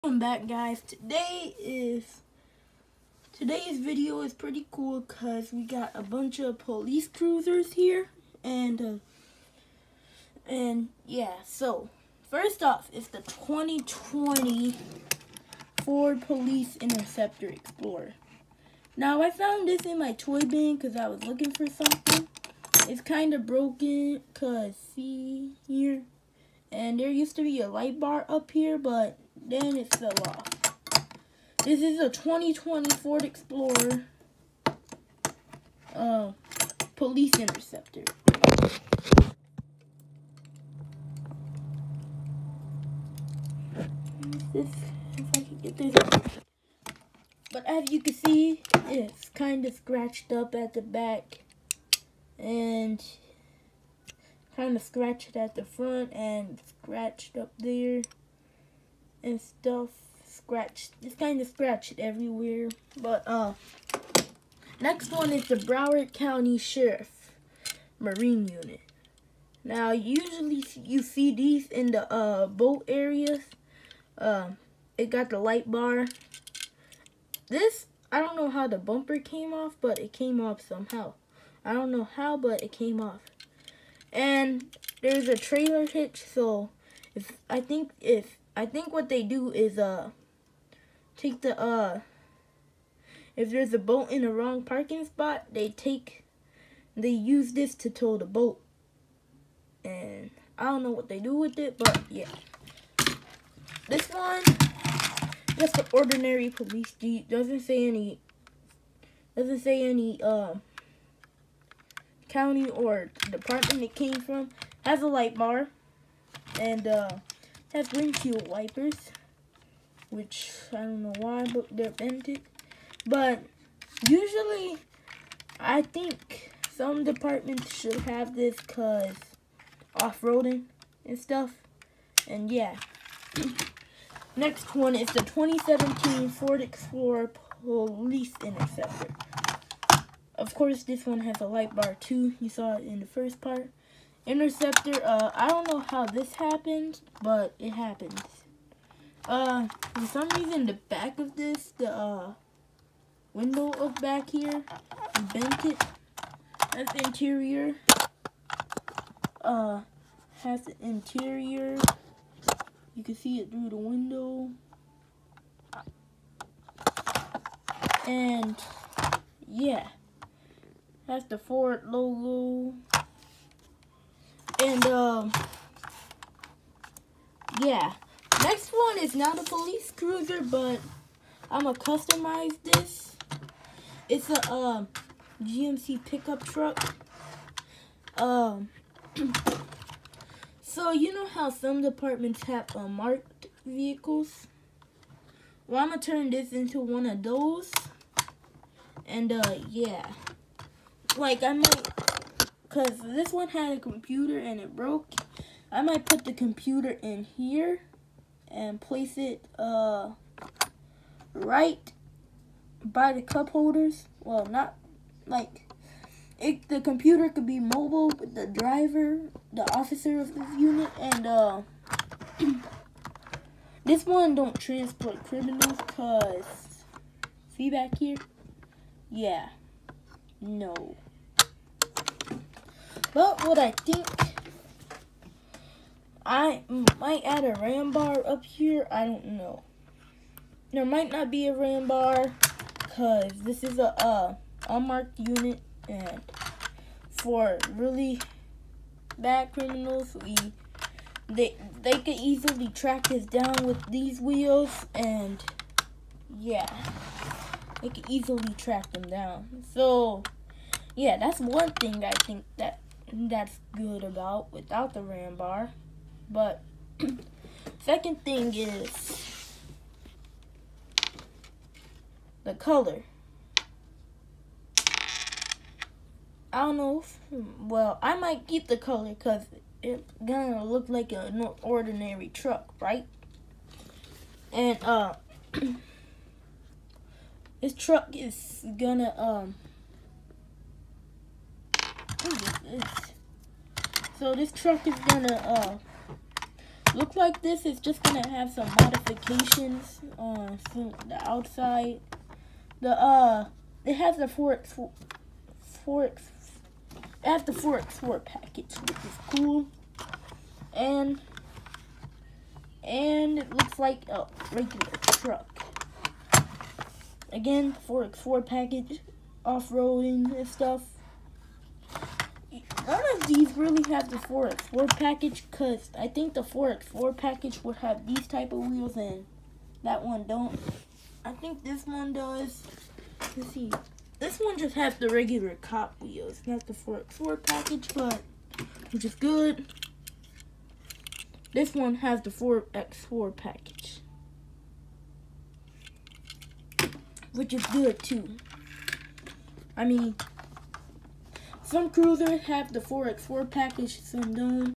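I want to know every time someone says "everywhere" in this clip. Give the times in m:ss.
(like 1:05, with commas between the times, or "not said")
1:01.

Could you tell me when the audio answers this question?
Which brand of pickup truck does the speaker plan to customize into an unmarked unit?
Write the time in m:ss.
3:05.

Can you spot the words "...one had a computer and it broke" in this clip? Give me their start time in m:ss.
3:23.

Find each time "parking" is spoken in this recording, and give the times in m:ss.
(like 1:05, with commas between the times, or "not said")
1:34.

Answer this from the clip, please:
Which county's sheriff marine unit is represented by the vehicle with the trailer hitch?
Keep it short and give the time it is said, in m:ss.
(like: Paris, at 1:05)
Broward County, at 1:05.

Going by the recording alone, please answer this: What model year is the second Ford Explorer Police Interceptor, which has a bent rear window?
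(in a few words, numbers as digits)
2017.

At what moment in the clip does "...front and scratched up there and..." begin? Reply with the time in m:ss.
0:55.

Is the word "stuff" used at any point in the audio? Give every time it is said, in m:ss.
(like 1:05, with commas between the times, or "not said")
0:59, 2:11, 5:20.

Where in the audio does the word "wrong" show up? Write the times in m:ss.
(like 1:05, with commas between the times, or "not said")
1:34.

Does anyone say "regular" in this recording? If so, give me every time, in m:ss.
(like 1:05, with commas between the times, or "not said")
5:14, 5:35.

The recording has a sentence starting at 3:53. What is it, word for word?
But what I think, I might add a RAM bar up here.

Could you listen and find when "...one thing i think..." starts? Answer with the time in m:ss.
4:21.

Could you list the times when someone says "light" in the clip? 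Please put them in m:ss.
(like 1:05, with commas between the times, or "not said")
0:27, 1:15, 1:55, 2:21.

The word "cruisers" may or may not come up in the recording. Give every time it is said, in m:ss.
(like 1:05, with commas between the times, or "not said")
0:07, 2:59, 5:51.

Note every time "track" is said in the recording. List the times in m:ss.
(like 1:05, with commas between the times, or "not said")
4:12, 4:18.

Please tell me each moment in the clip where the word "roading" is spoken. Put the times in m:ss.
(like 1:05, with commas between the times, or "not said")
2:10, 5:19.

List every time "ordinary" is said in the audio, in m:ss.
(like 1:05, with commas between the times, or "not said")
1:45, 4:41.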